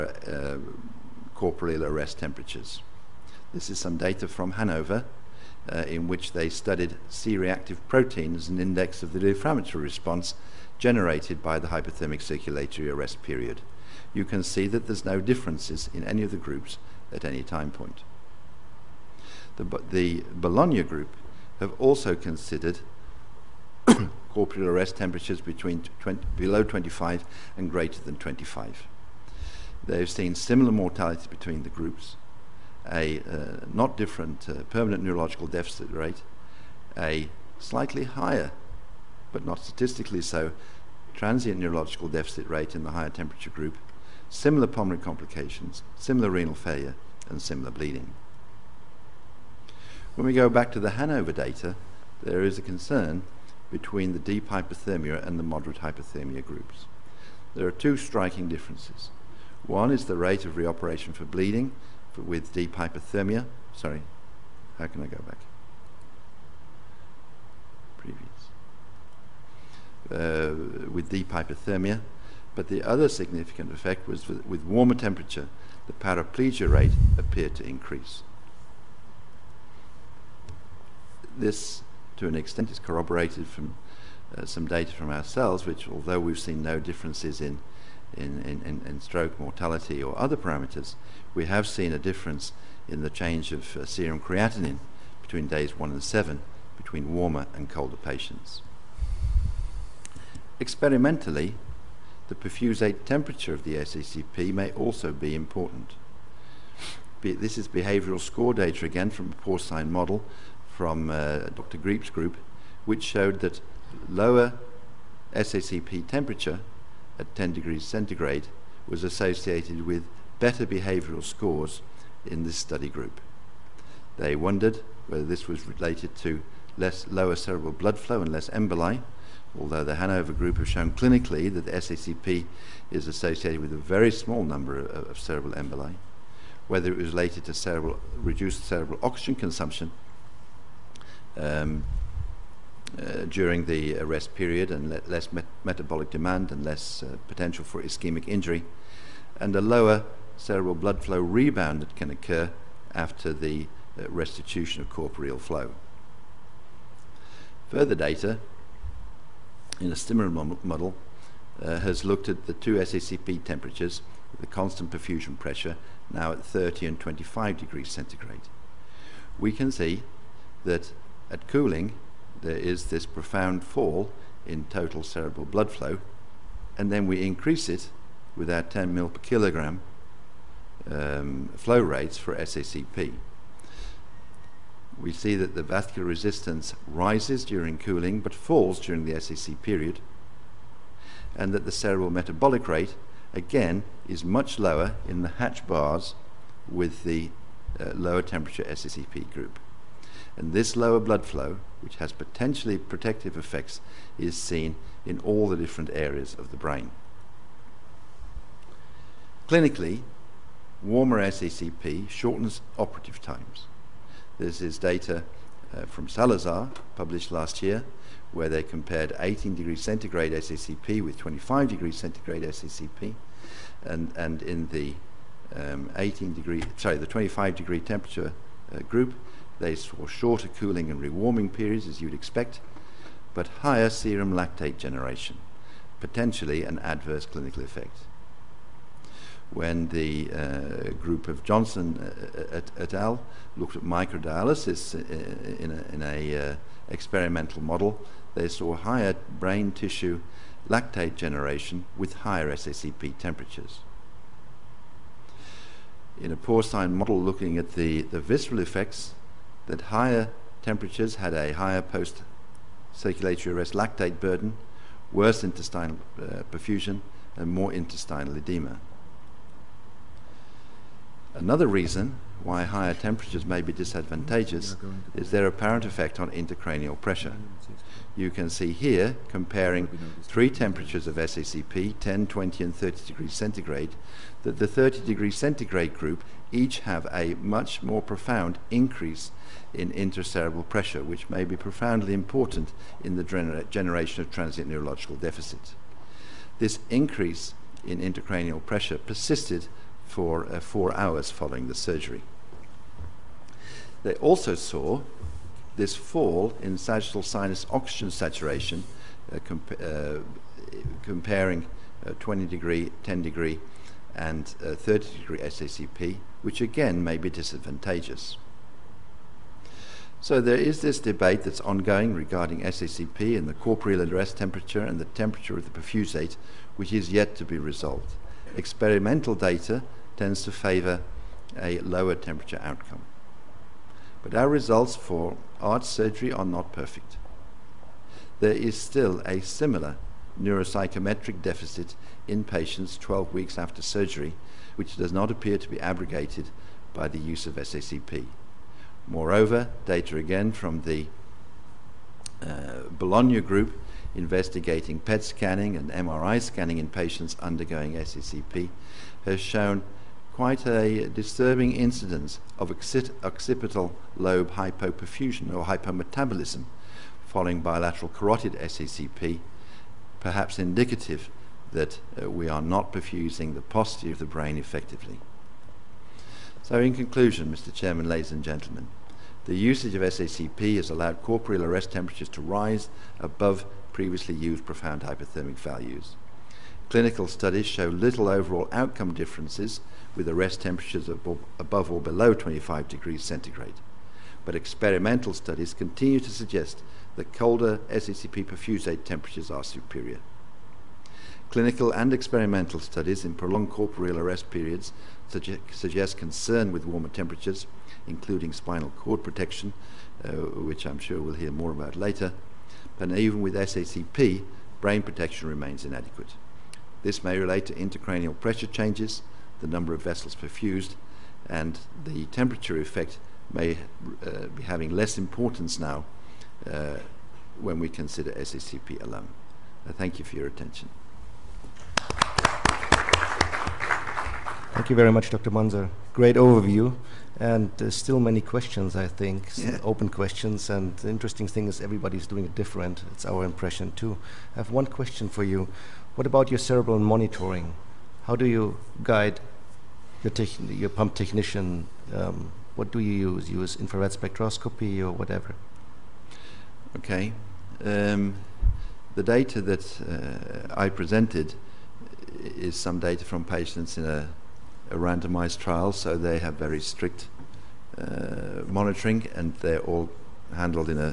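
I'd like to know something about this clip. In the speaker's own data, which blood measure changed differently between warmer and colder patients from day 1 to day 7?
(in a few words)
Serum creatinine.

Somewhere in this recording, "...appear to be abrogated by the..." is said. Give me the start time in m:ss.
5:45.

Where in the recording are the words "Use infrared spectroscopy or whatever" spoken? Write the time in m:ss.
7:33.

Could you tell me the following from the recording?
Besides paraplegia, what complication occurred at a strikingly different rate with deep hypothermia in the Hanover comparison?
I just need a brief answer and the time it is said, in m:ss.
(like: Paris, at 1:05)
Reoperation for bleeding, at 1:00.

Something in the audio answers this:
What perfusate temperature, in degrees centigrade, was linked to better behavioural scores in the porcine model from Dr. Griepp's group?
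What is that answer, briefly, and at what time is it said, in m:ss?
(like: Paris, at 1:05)
10, at 1:57.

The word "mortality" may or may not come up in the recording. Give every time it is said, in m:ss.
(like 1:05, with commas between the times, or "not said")
0:30, 1:29.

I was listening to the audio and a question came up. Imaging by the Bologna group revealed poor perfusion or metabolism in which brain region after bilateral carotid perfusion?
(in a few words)
Occipital lobe.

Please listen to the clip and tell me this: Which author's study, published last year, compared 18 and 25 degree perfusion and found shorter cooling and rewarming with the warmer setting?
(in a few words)
Salazar.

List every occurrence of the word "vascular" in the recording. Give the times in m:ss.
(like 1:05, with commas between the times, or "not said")
3:05.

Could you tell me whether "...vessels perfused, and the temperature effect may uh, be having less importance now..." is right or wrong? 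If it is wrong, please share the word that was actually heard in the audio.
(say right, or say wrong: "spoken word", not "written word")
right.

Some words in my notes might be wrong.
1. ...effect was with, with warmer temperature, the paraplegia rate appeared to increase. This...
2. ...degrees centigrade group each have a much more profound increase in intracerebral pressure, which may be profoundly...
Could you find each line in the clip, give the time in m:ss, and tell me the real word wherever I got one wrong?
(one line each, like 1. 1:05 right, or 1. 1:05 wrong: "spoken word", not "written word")
1. 1:13 right
2. 4:45 right.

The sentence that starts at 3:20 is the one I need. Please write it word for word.
And this lower blood flow, which has potentially protective effects, is seen in all the different areas of the brain.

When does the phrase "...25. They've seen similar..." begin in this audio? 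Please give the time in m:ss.
0:28.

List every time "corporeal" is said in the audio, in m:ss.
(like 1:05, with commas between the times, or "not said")
0:01, 0:24, 2:34, 5:23, 6:21, 6:43.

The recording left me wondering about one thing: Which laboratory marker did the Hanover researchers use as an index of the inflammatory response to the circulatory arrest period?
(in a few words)
C-reactive protein.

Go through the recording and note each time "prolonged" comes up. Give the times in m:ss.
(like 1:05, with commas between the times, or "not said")
6:43.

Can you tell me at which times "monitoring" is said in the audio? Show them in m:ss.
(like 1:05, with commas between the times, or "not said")
7:26, 7:48.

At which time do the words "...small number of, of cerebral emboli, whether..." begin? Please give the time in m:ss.
2:14.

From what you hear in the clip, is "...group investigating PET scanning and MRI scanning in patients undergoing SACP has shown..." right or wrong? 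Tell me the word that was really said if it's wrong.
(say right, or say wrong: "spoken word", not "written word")
right.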